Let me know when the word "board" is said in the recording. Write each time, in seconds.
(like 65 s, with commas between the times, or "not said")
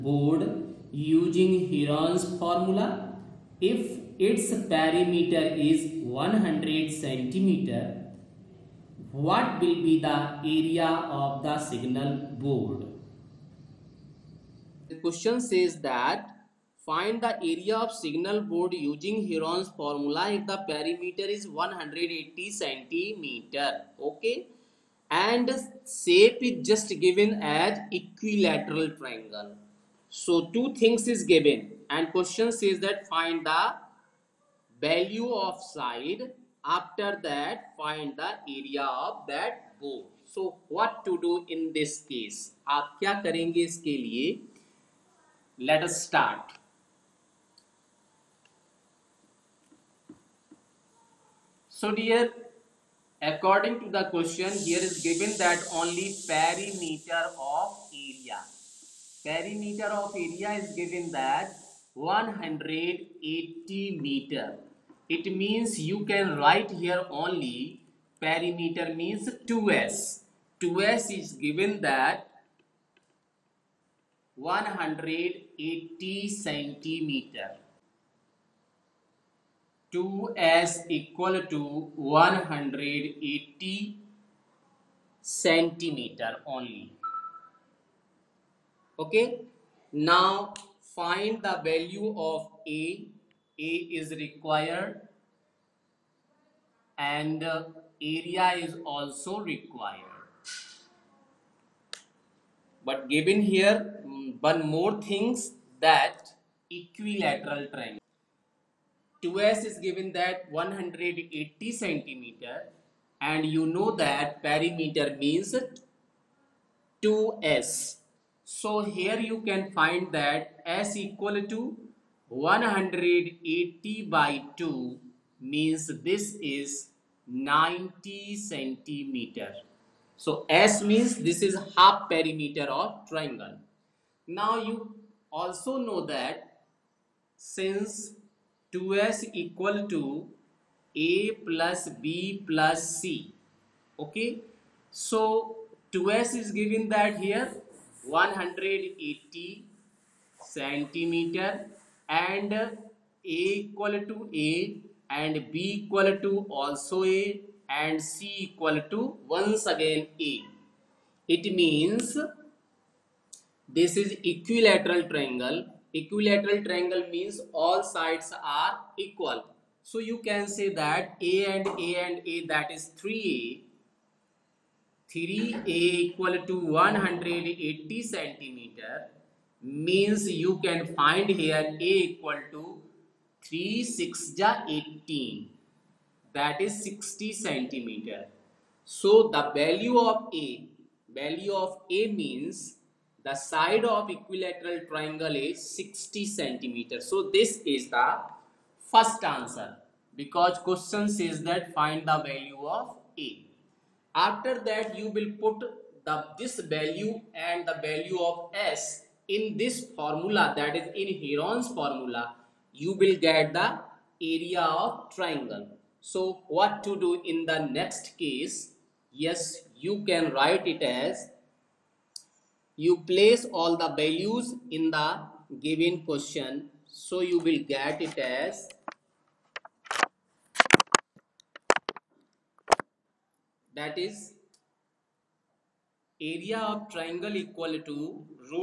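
0 s, 12 s, 18 s.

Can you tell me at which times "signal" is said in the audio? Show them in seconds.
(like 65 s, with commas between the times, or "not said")
11 s, 17 s.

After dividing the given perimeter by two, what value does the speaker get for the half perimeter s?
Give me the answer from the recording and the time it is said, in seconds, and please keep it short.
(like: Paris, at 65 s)
90 centimeter, at 127 s.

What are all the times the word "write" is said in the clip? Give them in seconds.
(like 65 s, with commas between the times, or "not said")
66 s, 220 s.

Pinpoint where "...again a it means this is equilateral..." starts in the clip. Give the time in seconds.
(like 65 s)
159 s.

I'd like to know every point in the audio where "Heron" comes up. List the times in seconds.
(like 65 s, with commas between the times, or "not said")
1 s, 19 s, 211 s.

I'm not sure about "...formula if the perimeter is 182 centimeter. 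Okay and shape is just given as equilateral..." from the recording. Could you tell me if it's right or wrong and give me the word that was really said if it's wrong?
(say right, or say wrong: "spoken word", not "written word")
wrong: "180", not "182".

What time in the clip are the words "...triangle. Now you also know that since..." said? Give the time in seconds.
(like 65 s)
133 s.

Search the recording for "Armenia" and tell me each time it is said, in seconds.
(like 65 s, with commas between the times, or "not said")
not said.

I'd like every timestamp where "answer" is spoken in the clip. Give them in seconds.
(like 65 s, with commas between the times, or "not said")
199 s.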